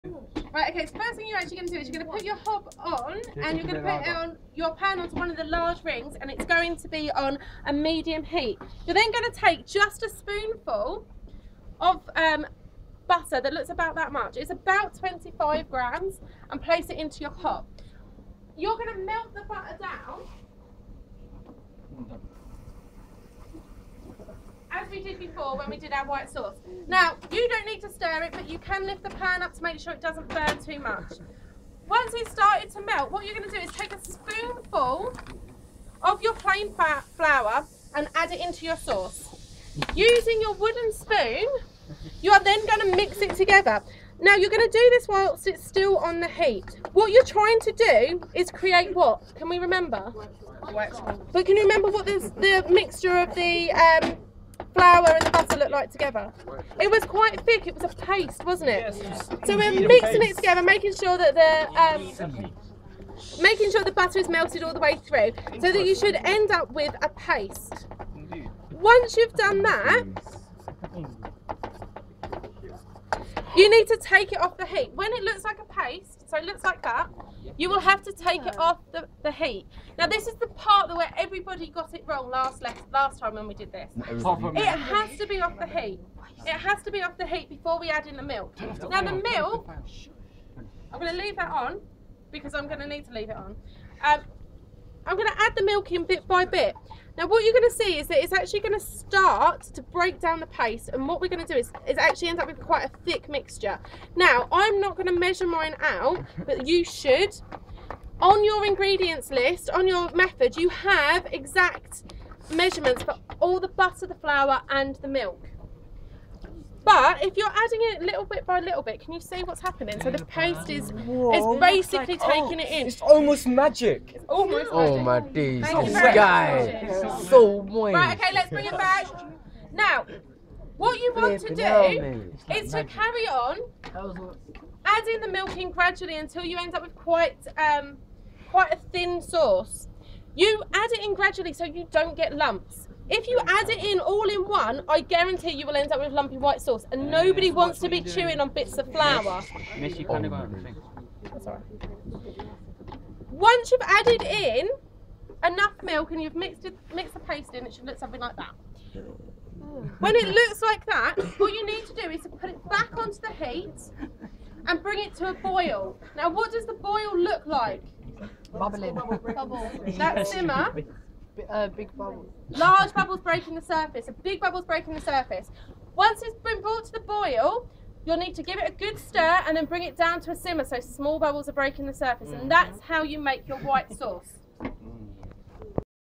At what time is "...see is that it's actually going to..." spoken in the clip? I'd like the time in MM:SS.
01:37.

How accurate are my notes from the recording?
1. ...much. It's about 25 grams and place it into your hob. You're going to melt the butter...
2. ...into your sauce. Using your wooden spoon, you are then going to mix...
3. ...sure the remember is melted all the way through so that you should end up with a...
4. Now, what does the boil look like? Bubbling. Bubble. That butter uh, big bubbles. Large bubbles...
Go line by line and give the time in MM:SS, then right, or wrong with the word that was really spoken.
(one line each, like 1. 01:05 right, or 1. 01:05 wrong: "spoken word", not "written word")
1. 00:14 right
2. 00:38 right
3. 01:03 wrong: "butter", not "remember"
4. 02:46 wrong: "simmer", not "butter".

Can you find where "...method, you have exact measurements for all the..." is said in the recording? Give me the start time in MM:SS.
01:50.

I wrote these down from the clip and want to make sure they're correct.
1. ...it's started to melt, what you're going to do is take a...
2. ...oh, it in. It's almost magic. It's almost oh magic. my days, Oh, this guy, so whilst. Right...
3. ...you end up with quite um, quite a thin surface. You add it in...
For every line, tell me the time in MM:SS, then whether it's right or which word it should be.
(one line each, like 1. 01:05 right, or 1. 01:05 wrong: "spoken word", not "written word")
1. 00:32 right
2. 02:02 wrong: "moist", not "whilst"
3. 02:16 wrong: "sauce", not "surface".